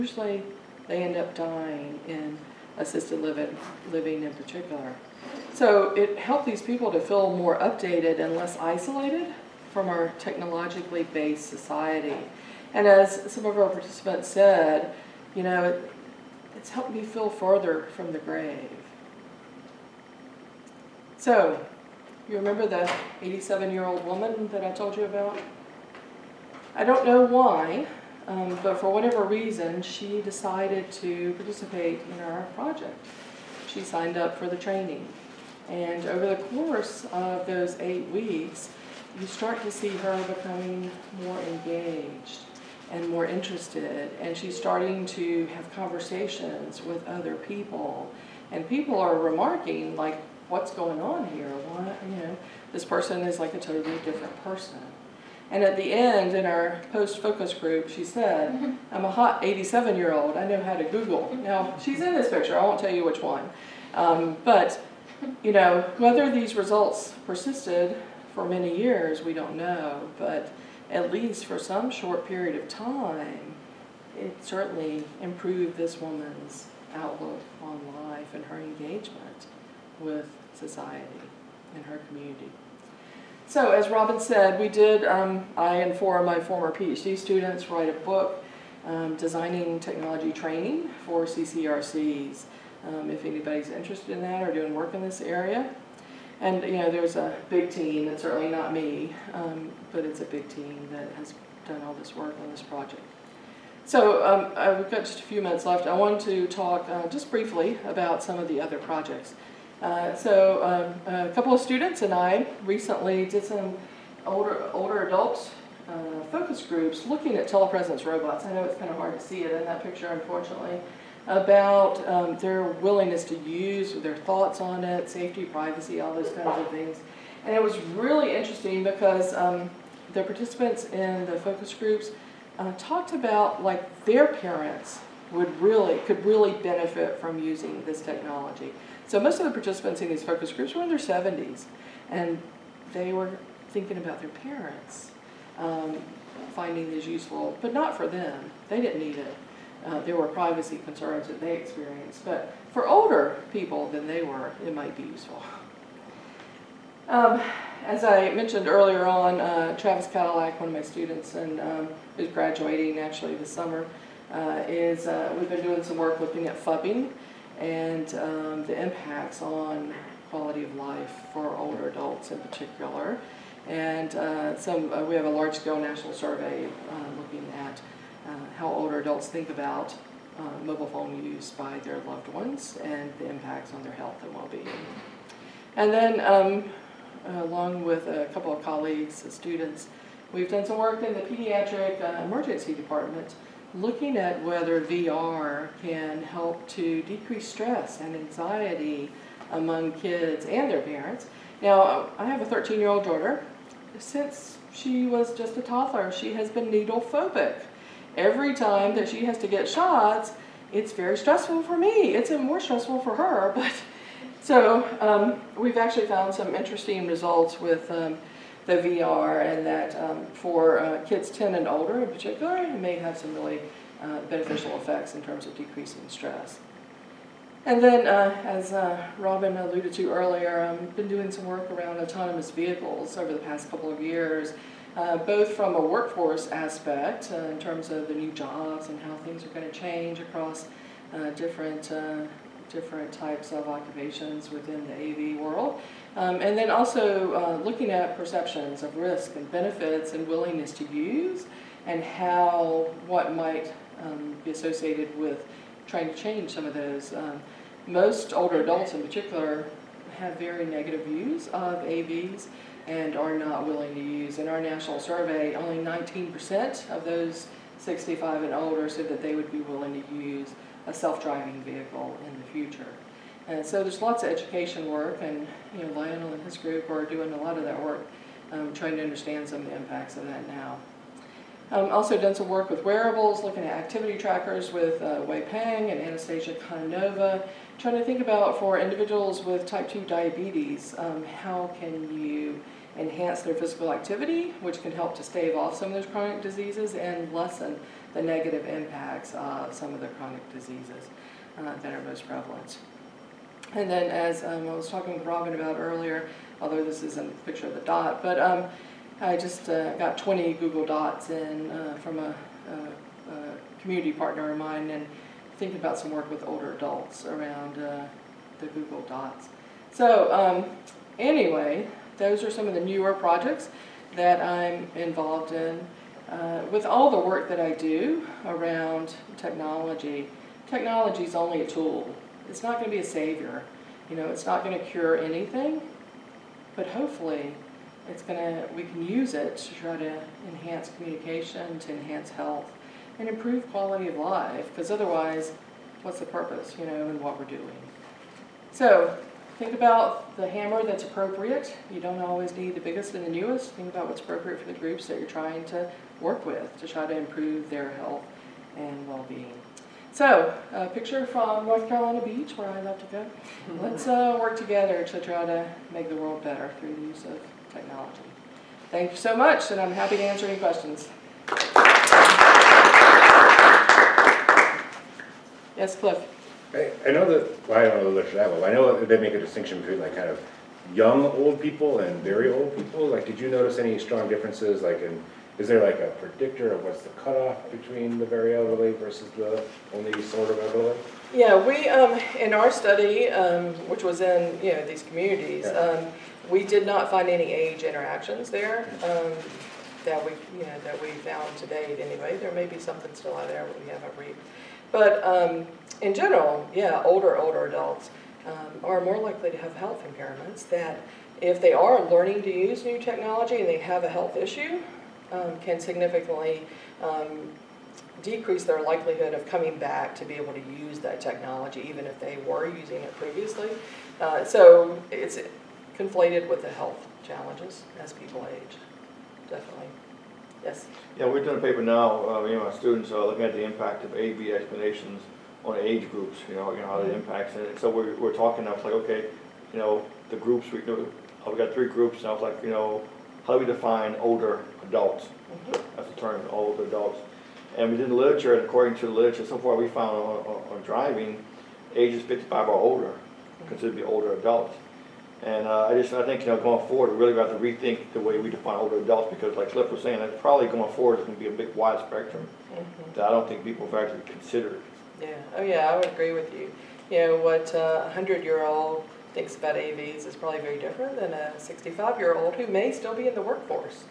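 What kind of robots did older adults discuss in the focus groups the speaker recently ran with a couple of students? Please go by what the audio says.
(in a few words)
telepresence robots.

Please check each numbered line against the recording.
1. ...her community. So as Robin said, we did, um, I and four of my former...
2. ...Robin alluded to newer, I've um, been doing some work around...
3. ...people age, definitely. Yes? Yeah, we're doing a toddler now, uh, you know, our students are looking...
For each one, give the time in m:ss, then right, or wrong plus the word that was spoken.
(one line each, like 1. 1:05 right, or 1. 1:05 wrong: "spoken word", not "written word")
1. 1:21 right
2. 3:49 wrong: "earlier", not "newer"
3. 7:08 wrong: "paper", not "toddler".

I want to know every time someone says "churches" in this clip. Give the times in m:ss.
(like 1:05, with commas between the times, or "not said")
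not said.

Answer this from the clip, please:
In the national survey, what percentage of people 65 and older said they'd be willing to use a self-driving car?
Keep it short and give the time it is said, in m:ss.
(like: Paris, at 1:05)
19%, at 4:25.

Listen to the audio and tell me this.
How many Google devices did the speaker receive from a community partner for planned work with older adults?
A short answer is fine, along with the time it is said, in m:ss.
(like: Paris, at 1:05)
20, at 5:10.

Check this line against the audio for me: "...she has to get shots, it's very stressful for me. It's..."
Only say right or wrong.
right.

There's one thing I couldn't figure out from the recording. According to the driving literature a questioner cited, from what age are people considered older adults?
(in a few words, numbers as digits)
55.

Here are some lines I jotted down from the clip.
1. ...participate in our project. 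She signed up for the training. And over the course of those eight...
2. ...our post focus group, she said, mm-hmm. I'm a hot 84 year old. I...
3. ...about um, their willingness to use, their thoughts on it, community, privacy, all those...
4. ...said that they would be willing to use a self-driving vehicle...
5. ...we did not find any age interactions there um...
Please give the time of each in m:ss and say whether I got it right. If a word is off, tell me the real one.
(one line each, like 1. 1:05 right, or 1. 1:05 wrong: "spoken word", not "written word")
1. 0:31 right
2. 0:56 wrong: "87", not "84"
3. 2:01 wrong: "safety", not "community"
4. 4:28 right
5. 6:36 right.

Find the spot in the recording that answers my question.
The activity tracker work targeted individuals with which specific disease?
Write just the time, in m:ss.
4:49.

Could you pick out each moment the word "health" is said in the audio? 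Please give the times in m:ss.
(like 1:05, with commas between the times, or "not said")
3:03, 5:42, 5:57, 6:49, 6:54, 7:06.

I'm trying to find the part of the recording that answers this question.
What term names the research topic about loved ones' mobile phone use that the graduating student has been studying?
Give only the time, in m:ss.
2:46.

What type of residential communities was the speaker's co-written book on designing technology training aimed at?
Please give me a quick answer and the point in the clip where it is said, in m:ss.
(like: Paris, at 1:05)
CCRCs, at 1:31.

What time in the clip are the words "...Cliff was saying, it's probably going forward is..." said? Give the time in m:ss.
7:39.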